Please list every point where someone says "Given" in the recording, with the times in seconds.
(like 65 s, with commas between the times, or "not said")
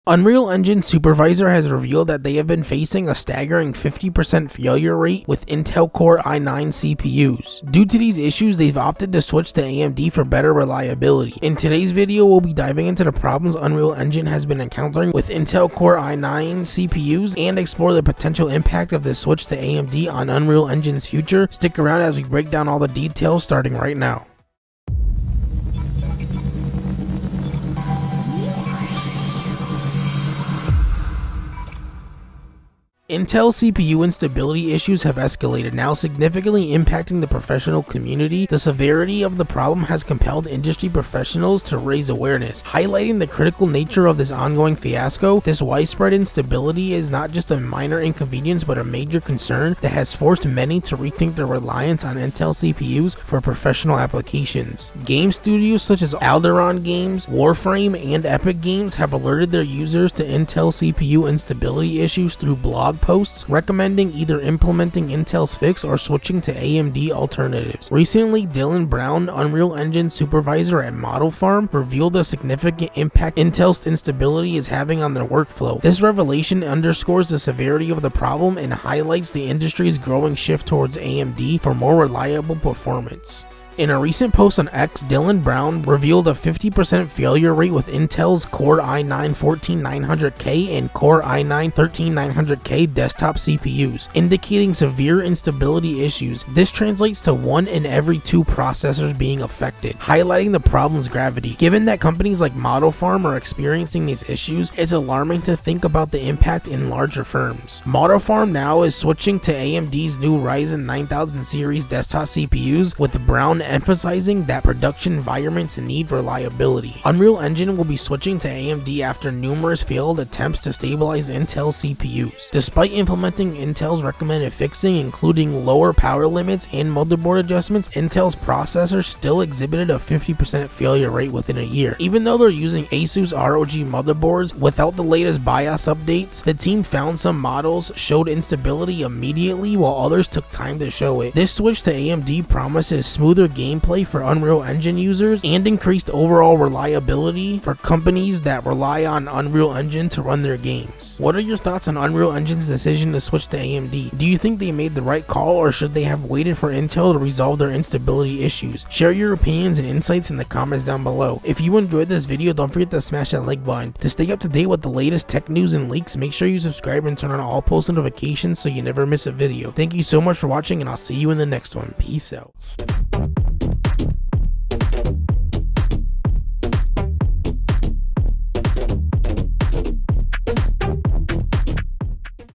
101 s.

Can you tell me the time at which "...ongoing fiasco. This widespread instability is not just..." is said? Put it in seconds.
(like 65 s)
44 s.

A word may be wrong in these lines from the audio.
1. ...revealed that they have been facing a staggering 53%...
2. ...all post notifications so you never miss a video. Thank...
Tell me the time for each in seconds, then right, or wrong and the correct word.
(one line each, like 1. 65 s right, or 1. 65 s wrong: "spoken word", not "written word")
1. 1 s wrong: "50", not "53"
2. 167 s right.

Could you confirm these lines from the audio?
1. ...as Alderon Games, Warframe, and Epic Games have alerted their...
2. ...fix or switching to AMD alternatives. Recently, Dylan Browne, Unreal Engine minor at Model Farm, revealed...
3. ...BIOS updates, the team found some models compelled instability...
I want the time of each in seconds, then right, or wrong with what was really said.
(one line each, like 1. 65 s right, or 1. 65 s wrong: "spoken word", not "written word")
1. 56 s right
2. 65 s wrong: "supervisor", not "minor"
3. 135 s wrong: "showed", not "compelled".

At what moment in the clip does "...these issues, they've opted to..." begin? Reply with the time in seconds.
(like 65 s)
7 s.